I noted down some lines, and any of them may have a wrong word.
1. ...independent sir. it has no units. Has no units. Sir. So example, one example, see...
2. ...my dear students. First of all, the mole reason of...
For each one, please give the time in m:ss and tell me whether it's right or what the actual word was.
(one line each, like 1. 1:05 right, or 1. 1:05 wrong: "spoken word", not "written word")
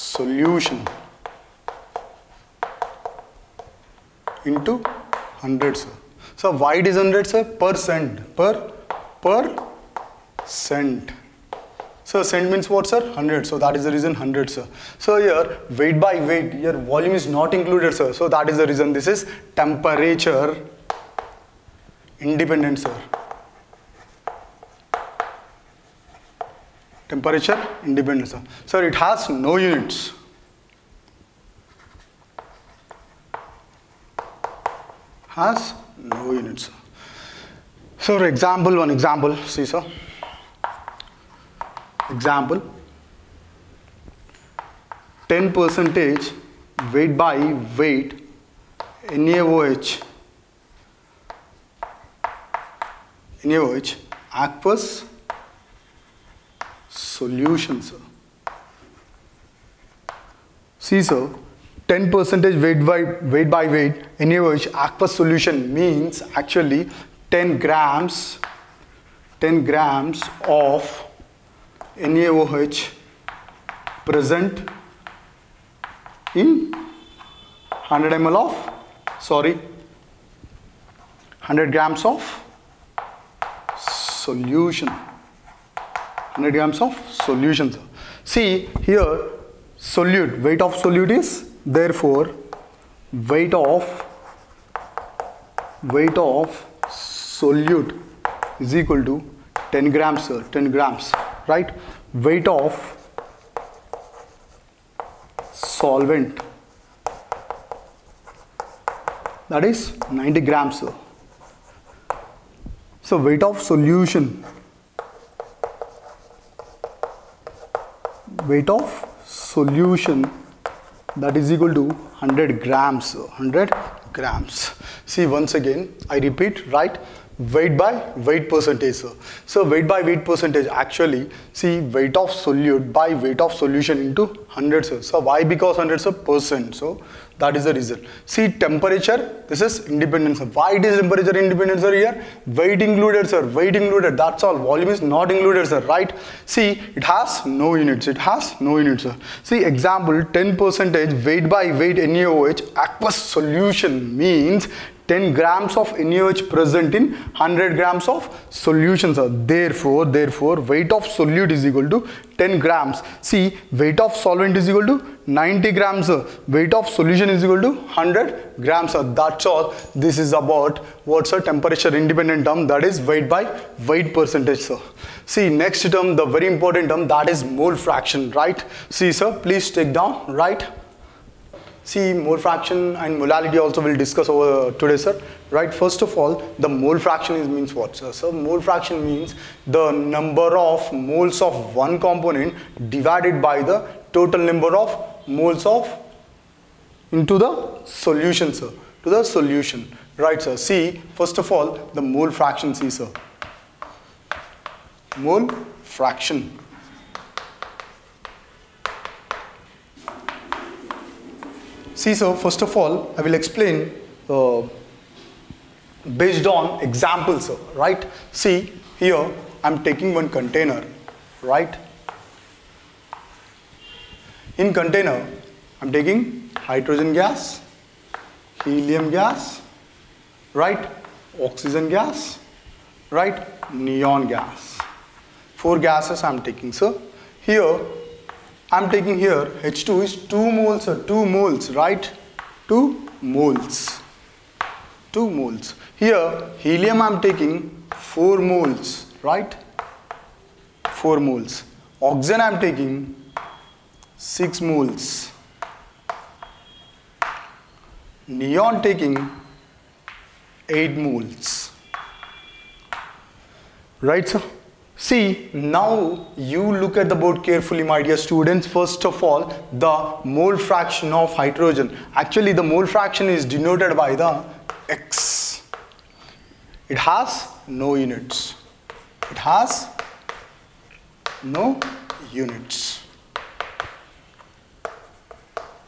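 1. 0:27 right
2. 4:27 wrong: "fraction", not "reason".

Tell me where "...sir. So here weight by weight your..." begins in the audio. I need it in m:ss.
0:14.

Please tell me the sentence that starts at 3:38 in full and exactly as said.
See, here I'm taking one container, right?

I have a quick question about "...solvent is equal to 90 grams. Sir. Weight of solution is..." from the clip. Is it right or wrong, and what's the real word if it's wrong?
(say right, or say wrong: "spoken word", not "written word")
right.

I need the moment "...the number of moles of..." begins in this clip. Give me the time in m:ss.
3:09.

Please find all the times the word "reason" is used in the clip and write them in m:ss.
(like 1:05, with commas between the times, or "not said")
0:13, 0:18, 2:17.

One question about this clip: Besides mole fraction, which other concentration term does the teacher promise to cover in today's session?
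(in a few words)
Molality.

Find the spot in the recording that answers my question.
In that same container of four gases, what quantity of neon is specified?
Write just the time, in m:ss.
4:18.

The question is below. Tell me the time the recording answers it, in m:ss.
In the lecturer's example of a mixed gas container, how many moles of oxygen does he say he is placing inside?
4:12.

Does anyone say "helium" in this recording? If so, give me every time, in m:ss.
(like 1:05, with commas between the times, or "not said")
3:48, 4:06.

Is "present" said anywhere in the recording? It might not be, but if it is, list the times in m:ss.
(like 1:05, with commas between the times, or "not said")
1:14, 2:36.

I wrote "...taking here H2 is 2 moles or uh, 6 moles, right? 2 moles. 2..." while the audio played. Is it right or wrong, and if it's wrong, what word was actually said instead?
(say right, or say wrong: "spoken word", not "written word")
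wrong: "2", not "6".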